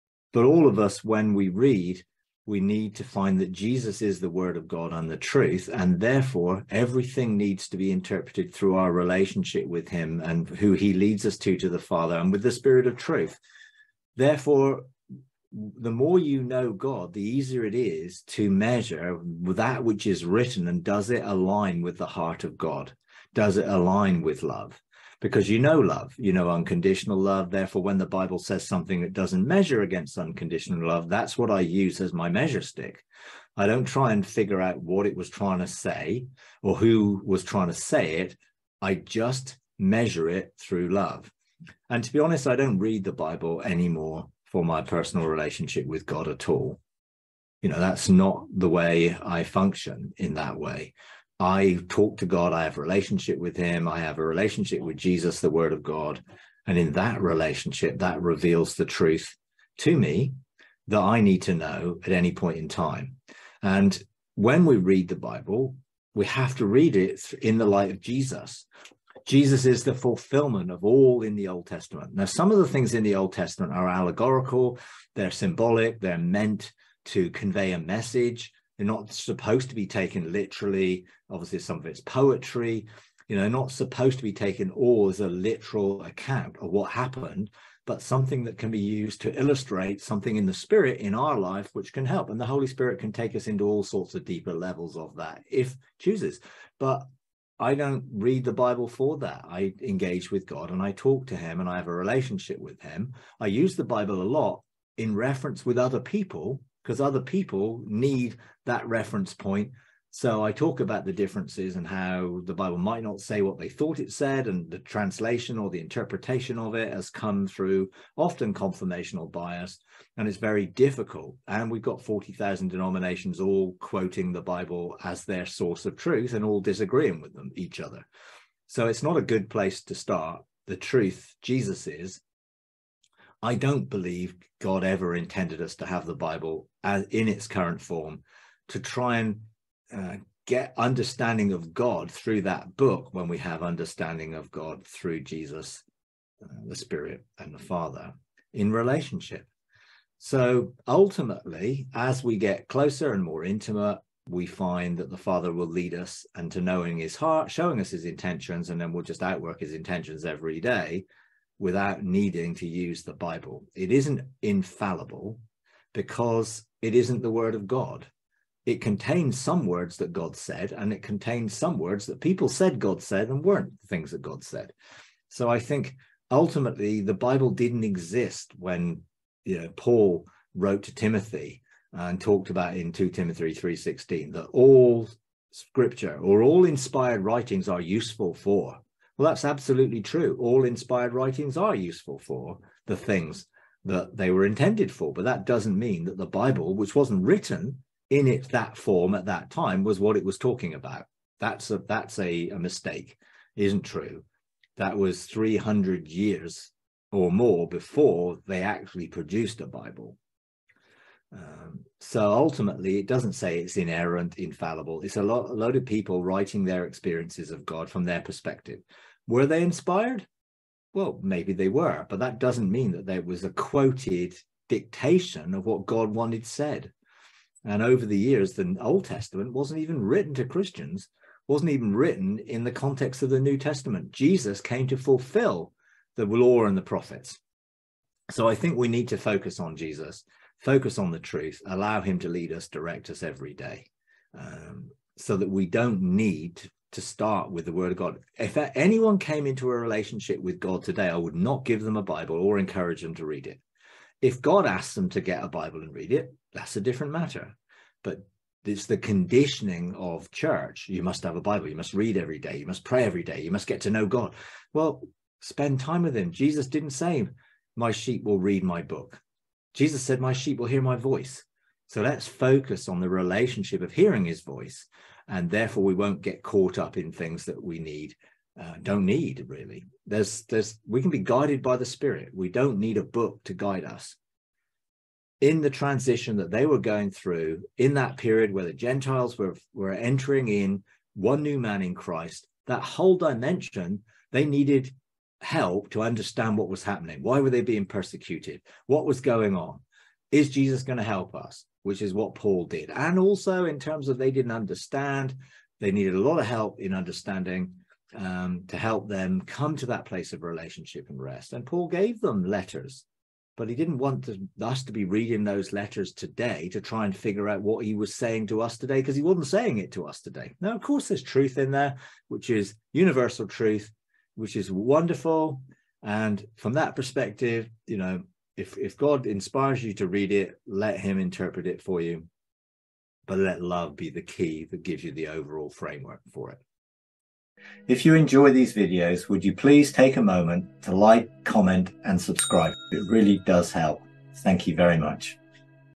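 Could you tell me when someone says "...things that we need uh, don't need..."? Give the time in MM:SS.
04:37.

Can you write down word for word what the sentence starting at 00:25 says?
because you know love, you know unconditional love.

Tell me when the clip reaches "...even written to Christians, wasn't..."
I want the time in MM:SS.
03:49.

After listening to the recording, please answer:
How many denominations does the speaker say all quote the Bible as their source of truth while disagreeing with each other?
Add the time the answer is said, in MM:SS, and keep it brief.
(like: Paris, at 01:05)
40,000, at 02:02.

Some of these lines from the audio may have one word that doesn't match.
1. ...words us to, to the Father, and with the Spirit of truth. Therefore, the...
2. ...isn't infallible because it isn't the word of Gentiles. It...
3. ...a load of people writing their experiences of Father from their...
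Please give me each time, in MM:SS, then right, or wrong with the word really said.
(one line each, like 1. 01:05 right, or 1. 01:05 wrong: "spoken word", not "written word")
1. 00:10 wrong: "leads", not "words"
2. 02:43 wrong: "God", not "Gentiles"
3. 03:35 wrong: "God", not "Father".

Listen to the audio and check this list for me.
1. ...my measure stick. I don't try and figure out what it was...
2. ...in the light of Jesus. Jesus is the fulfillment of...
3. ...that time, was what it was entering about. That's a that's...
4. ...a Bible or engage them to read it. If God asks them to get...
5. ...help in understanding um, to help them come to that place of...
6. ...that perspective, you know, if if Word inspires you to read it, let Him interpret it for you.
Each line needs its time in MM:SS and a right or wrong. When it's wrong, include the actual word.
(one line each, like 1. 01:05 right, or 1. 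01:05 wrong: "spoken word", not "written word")
1. 00:32 right
2. 01:07 right
3. 03:19 wrong: "talking", not "entering"
4. 04:11 wrong: "encourage", not "engage"
5. 05:06 right
6. 05:26 wrong: "God", not "Word".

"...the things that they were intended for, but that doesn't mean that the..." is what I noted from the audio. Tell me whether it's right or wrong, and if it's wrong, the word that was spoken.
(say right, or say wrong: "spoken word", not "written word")
right.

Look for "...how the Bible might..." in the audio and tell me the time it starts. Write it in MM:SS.
01:51.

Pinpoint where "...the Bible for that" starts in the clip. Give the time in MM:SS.
01:38.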